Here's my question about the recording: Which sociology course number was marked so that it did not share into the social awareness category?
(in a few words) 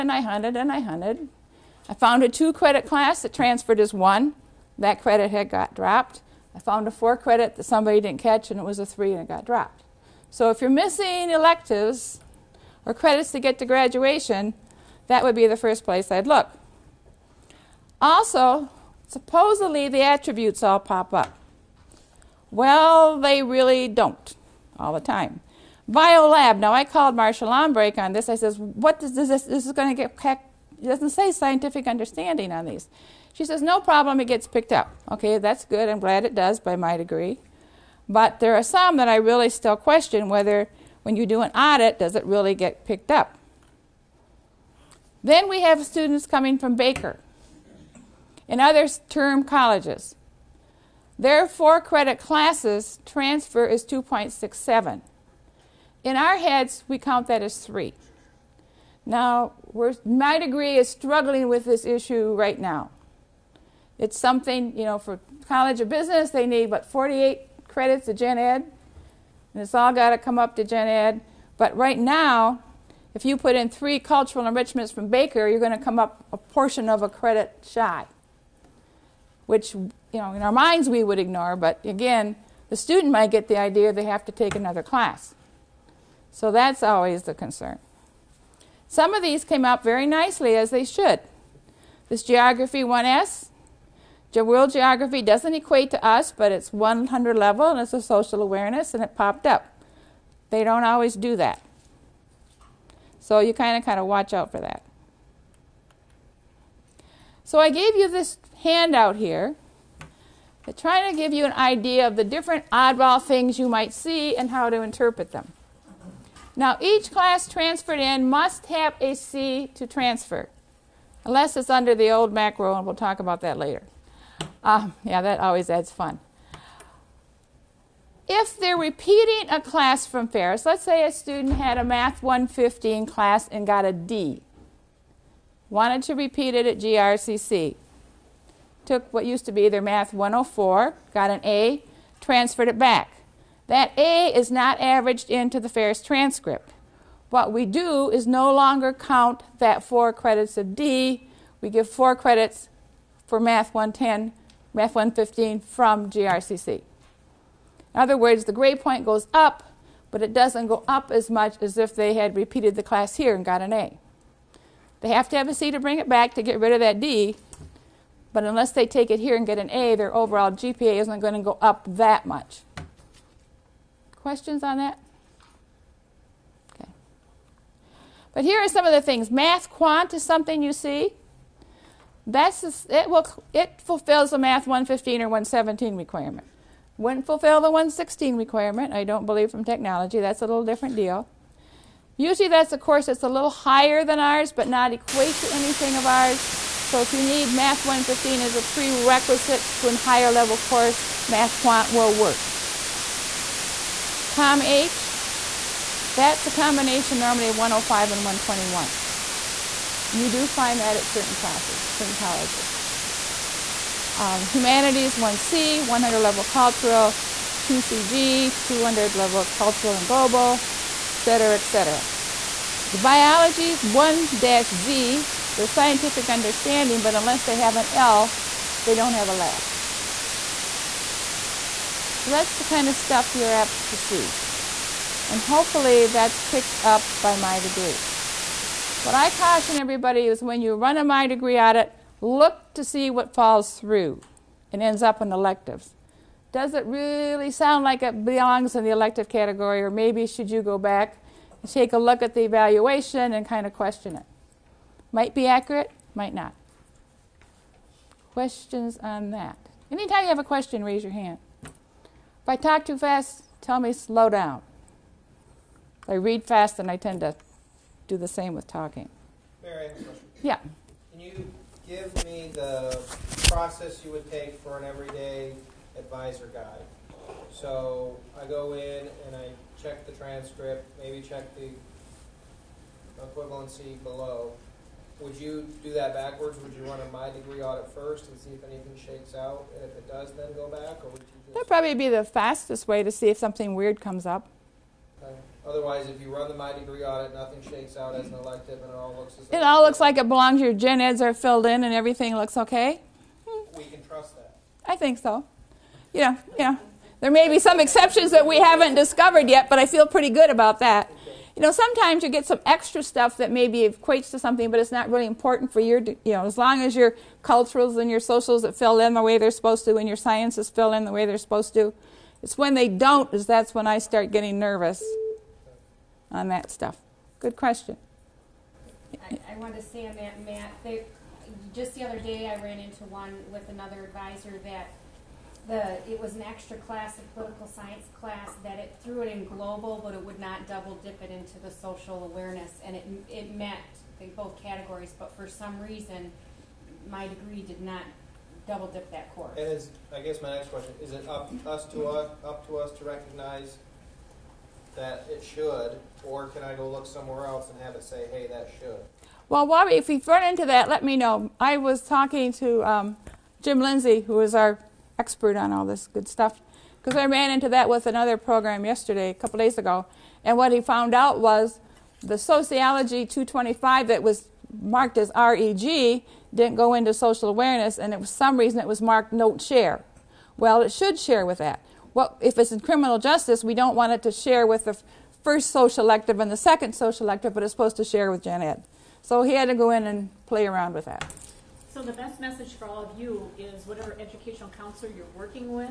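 225.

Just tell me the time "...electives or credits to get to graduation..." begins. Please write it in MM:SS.
00:11.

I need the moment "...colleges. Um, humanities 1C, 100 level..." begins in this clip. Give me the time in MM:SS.
03:32.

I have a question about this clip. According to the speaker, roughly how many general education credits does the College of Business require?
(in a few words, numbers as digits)
48.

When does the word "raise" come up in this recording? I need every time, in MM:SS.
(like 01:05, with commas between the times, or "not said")
04:20.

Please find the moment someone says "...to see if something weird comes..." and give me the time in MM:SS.
04:53.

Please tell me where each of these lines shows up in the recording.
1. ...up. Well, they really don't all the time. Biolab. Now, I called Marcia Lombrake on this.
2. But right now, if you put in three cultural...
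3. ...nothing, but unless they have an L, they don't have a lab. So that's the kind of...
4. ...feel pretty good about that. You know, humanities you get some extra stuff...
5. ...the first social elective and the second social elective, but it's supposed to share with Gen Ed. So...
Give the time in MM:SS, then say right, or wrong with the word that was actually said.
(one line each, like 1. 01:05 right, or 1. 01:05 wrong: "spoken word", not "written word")
1. 00:21 right
2. 01:11 right
3. 03:46 wrong: "understanding", not "nothing"
4. 05:09 wrong: "sometimes", not "humanities"
5. 06:24 right.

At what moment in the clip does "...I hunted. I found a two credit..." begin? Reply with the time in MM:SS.
00:00.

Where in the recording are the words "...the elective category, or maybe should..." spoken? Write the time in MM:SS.
04:08.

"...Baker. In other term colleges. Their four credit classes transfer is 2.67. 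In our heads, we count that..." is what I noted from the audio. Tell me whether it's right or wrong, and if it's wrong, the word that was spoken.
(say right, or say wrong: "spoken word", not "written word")
right.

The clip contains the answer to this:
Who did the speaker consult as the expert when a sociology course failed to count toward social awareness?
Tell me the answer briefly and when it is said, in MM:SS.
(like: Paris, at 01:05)
Jim Lindsay, at 06:03.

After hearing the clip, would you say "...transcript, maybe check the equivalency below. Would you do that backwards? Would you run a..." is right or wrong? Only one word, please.
right.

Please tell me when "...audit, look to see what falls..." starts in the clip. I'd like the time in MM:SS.
04:01.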